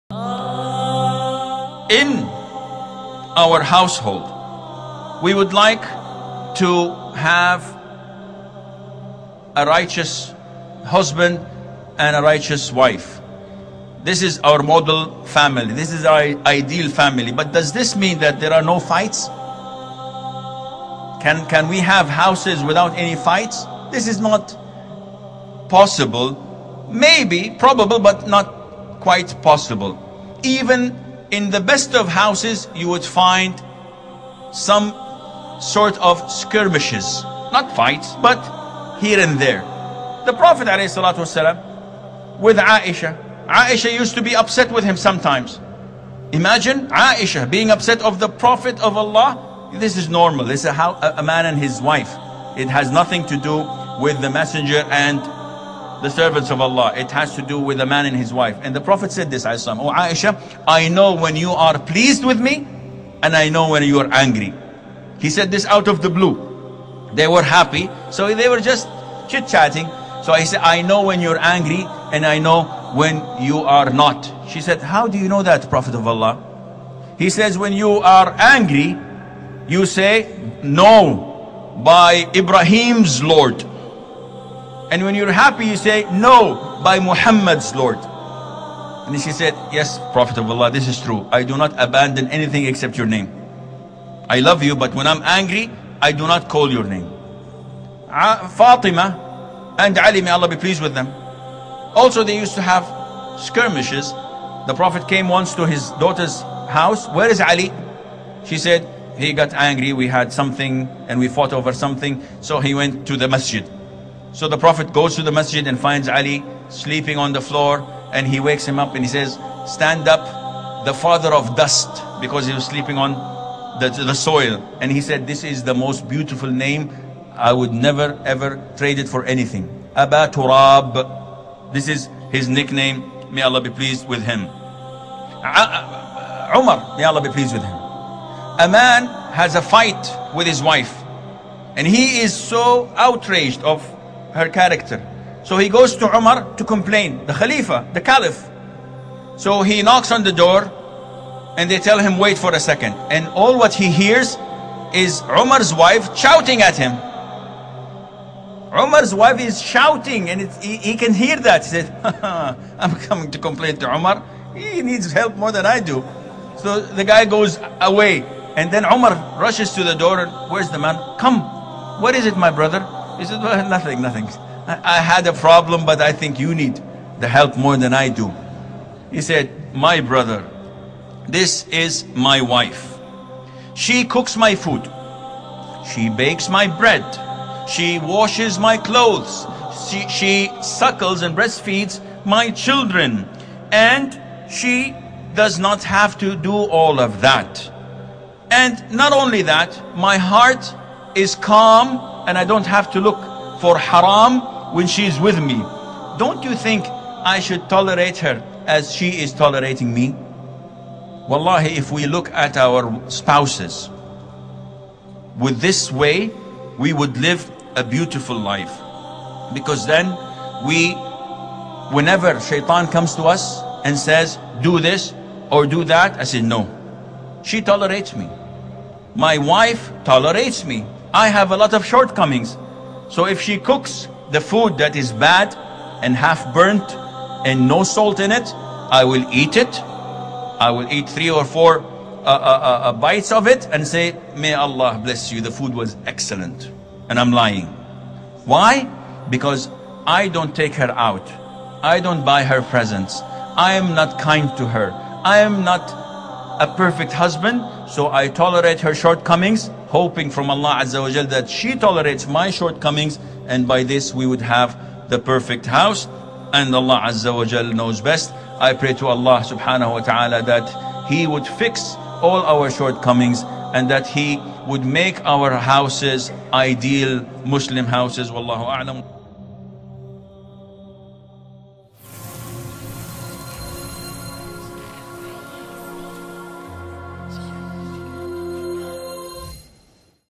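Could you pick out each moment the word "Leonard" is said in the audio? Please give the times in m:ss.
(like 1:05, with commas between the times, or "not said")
not said.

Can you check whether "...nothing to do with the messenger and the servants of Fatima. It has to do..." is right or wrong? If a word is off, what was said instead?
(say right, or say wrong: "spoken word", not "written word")
wrong: "Allah", not "Fatima".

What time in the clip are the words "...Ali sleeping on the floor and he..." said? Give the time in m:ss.
1:56.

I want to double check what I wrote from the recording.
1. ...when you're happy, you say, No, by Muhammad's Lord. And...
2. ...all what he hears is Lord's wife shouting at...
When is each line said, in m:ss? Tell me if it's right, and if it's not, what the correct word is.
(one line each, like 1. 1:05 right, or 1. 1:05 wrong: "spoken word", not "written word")
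1. 1:25 right
2. 2:33 wrong: "Umar", not "Lord".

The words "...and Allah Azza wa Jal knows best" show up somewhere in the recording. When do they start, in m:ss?
4:26.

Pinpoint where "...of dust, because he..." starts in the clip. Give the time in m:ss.
2:01.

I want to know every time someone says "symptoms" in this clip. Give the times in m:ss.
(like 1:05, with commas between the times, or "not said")
not said.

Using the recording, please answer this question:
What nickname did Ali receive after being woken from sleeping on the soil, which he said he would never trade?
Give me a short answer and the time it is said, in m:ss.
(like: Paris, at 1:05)
Aba Turab, at 2:09.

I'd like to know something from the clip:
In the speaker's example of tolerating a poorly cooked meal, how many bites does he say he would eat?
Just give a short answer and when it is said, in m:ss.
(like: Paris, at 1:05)
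3 or 4, at 4:01.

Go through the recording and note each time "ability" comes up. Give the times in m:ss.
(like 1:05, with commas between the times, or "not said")
not said.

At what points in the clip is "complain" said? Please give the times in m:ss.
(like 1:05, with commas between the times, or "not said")
2:26, 2:43.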